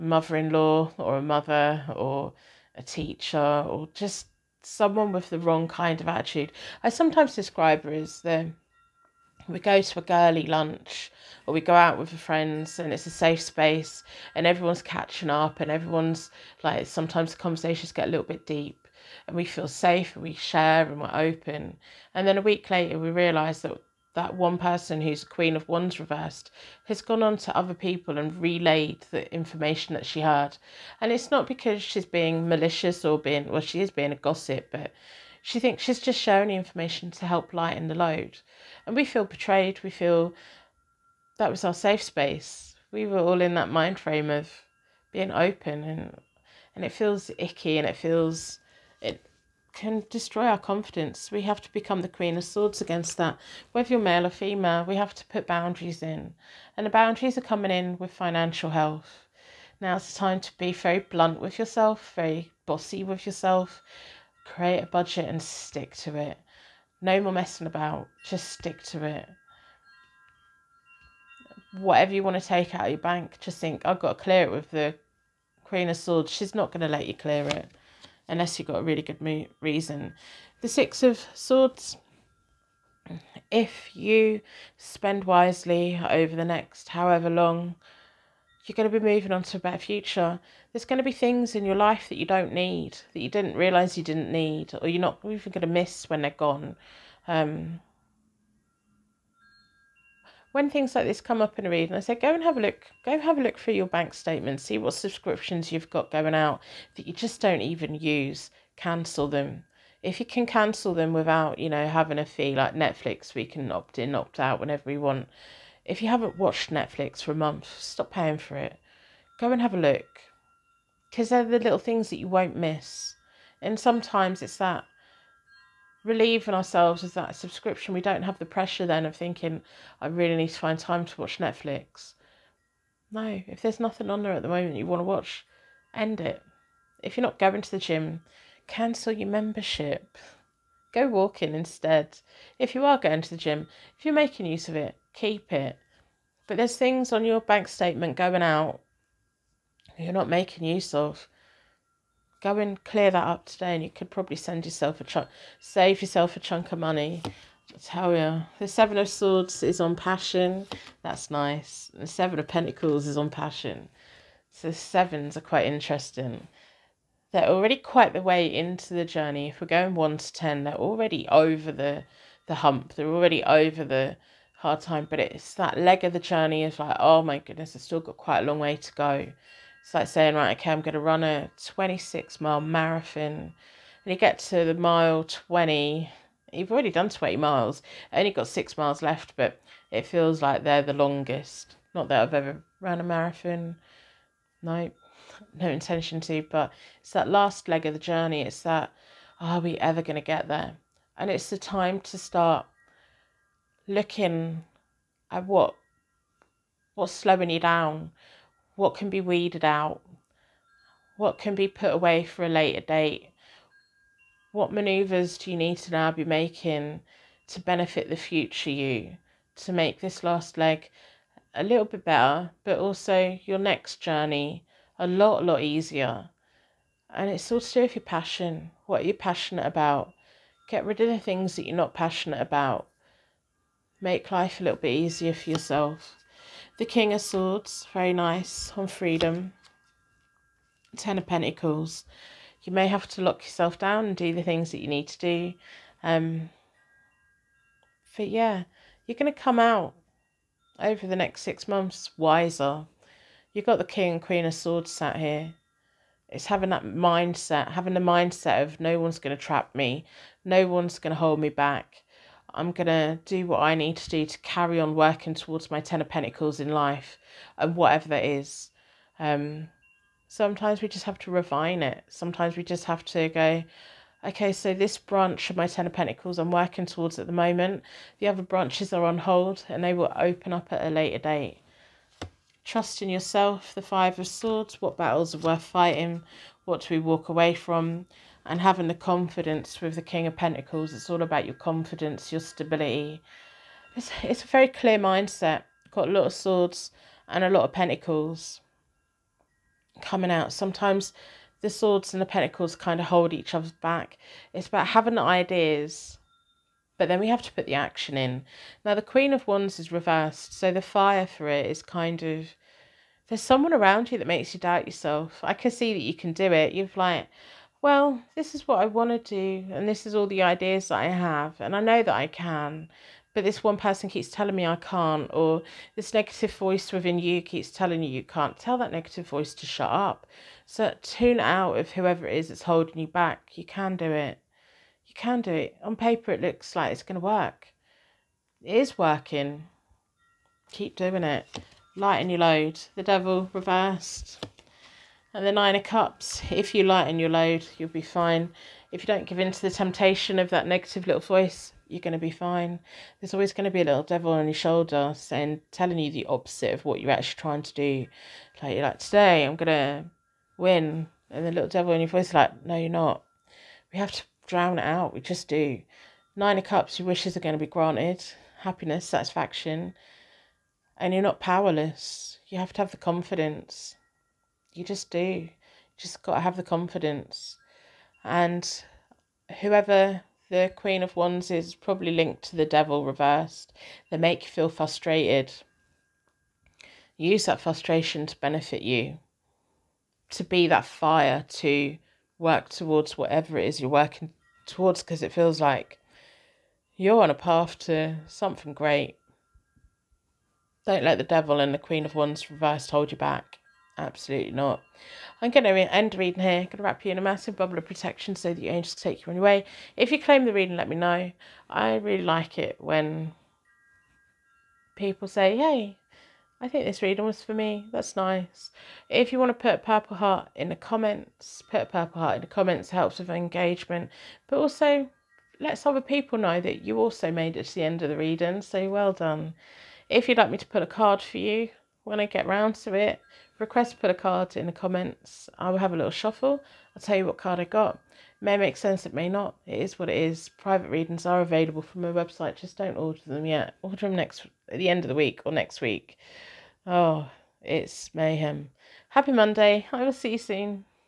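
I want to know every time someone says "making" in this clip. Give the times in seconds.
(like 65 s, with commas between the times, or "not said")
144 s, 150 s, 216 s.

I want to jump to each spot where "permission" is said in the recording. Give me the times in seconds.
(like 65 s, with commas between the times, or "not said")
not said.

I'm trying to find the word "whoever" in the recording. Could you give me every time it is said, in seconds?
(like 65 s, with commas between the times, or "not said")
331 s, 379 s.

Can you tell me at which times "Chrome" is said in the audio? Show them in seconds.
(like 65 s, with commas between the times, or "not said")
not said.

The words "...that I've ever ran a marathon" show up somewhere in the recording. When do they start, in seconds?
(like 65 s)
192 s.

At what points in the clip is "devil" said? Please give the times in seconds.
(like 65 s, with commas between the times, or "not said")
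343 s, 354 s, 361 s, 382 s, 401 s.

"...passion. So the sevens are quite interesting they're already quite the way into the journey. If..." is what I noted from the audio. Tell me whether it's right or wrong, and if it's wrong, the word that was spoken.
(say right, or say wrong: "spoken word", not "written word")
right.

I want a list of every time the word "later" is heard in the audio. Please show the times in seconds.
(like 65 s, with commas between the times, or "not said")
22 s, 212 s, 280 s.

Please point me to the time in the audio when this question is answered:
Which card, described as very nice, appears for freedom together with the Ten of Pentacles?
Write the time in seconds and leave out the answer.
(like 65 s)
236 s.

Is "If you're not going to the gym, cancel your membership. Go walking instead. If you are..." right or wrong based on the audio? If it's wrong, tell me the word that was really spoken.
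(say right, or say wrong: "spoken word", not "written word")
right.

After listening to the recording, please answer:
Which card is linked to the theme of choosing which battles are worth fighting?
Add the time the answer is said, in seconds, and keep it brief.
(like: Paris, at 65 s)
Five of Swords, at 283 s.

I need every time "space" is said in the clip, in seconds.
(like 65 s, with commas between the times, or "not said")
13 s, 42 s.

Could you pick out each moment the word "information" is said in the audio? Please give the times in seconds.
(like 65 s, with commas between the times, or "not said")
29 s, 36 s.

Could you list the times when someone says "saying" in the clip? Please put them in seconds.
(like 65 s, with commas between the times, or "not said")
180 s, 355 s.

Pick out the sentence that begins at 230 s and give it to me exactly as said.
Get rid of the things that you're not passionate about.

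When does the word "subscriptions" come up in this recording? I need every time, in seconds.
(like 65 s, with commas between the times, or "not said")
104 s, 127 s.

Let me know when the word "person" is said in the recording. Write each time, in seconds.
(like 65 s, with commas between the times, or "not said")
24 s, 323 s.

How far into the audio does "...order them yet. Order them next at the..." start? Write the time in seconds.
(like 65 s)
442 s.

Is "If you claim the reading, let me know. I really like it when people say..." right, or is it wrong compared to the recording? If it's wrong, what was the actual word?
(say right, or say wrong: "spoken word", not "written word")
right.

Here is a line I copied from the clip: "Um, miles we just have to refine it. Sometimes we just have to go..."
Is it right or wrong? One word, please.
wrong.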